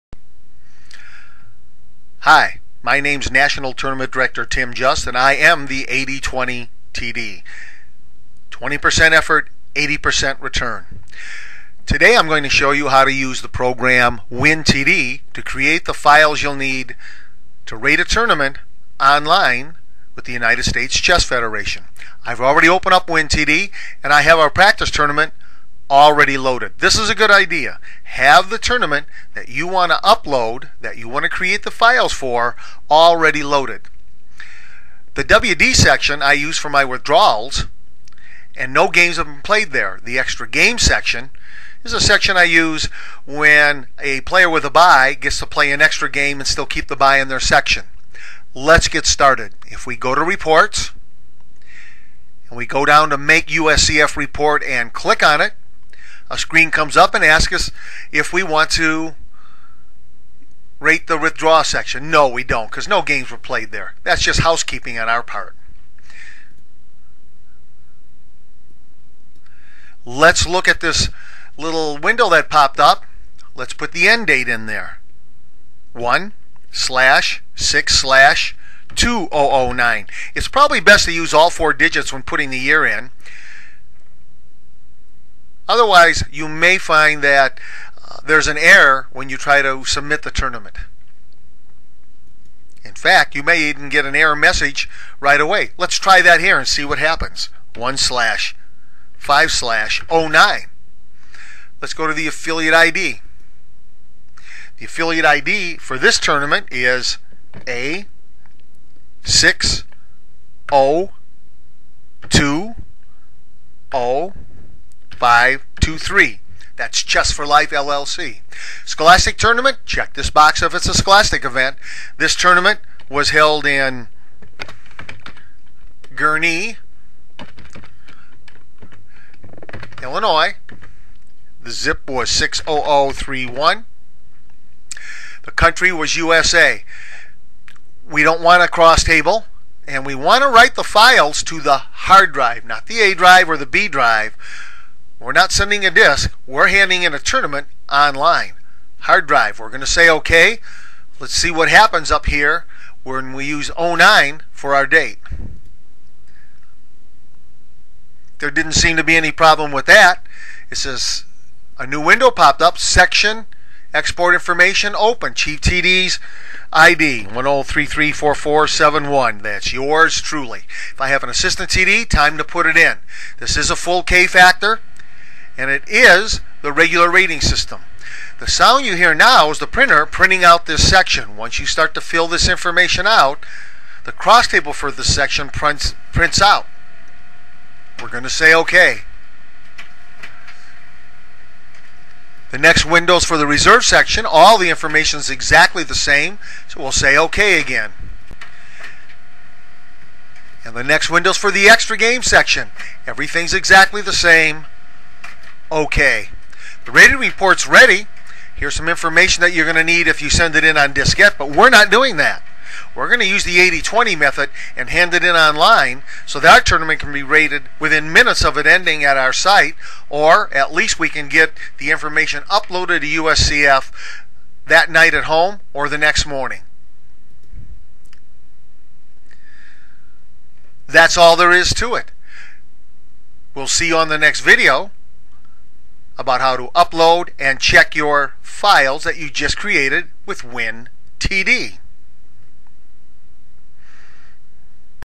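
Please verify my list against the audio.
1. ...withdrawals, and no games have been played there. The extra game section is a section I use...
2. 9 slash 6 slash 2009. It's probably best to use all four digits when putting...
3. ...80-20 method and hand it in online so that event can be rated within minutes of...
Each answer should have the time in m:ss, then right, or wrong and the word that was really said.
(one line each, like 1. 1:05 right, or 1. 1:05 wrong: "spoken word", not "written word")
1. 0:36 right
2. 1:15 wrong: "1", not "9"
3. 3:33 wrong: "tournament", not "event".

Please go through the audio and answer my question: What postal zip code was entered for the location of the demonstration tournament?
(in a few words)
60031.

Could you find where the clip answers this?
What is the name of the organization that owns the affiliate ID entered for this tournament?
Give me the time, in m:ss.
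1:57.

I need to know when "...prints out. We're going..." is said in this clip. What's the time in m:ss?
3:06.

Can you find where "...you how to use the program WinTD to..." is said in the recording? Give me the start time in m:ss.
0:12.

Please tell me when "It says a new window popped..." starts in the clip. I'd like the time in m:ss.
2:40.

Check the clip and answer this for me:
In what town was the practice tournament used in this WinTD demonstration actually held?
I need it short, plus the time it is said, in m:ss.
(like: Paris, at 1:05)
Gurnee, Illinois, at 2:06.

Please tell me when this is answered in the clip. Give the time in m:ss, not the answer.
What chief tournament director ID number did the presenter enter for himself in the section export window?
2:47.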